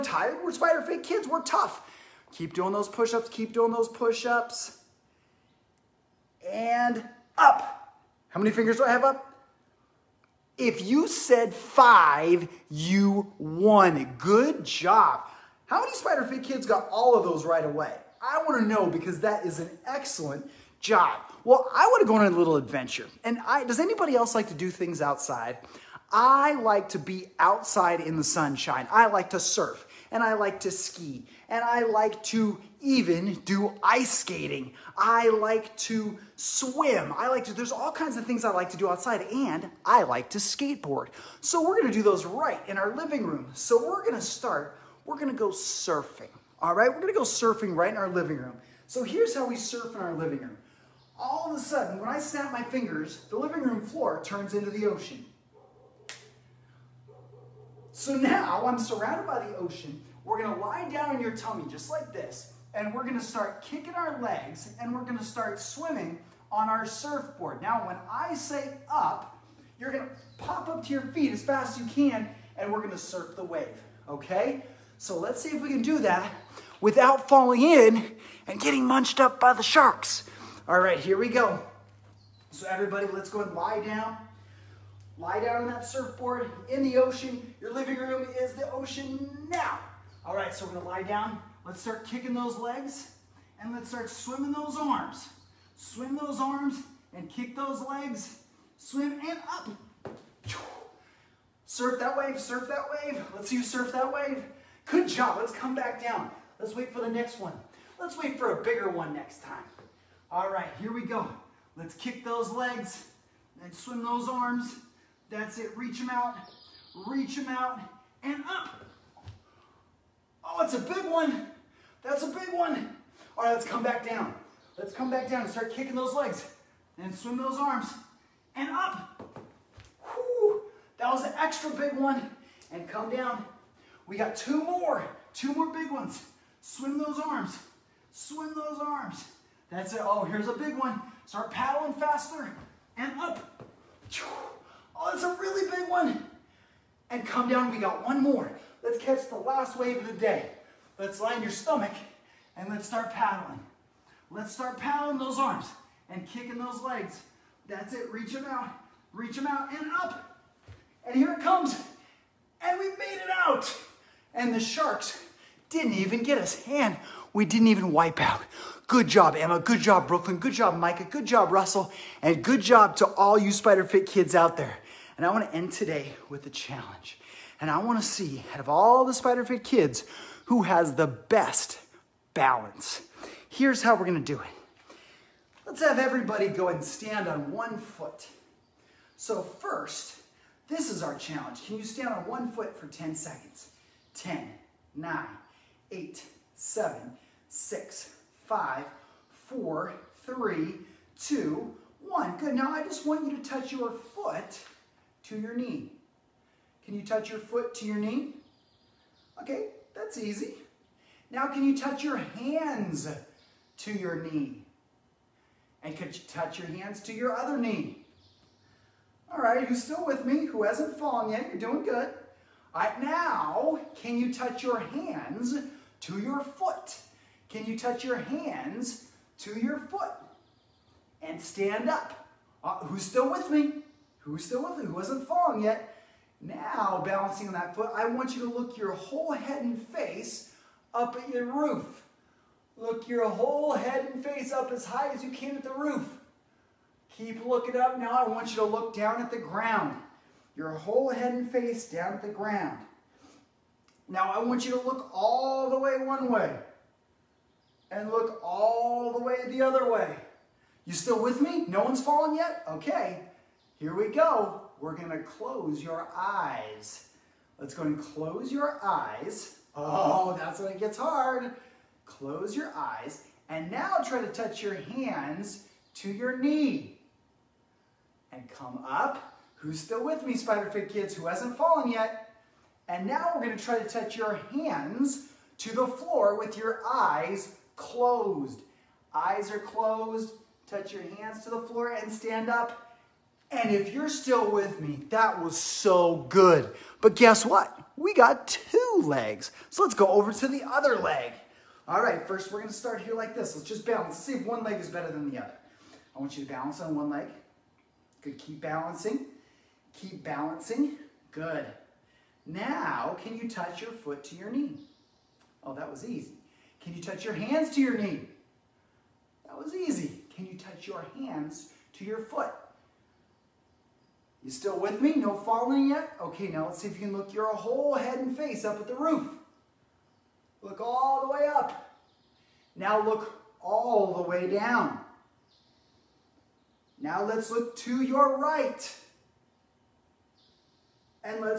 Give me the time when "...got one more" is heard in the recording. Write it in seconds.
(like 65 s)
147 s.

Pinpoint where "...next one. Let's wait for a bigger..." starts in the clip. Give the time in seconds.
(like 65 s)
107 s.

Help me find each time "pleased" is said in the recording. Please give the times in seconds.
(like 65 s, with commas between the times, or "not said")
not said.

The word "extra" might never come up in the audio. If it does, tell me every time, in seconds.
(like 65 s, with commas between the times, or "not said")
131 s.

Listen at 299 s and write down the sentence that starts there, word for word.
So let's go over to the other leg.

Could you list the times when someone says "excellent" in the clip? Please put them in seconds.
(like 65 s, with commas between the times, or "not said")
19 s.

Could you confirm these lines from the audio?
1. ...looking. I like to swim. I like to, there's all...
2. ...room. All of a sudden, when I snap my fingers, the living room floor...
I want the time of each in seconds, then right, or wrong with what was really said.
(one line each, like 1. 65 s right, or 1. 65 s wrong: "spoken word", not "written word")
1. 34 s wrong: "skating", not "looking"
2. 50 s right.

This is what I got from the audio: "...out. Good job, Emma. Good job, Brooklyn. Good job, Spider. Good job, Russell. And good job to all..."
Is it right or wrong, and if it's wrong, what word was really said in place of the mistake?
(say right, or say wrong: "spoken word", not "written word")
wrong: "Micah", not "Spider".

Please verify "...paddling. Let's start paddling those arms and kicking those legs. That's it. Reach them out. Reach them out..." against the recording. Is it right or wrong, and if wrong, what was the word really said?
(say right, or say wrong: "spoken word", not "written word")
right.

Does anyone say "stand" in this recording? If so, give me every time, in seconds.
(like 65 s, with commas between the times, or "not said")
186 s, 191 s, 231 s, 292 s.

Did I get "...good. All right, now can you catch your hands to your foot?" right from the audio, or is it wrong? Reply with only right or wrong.
wrong.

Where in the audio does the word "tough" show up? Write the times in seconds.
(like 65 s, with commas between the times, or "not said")
1 s.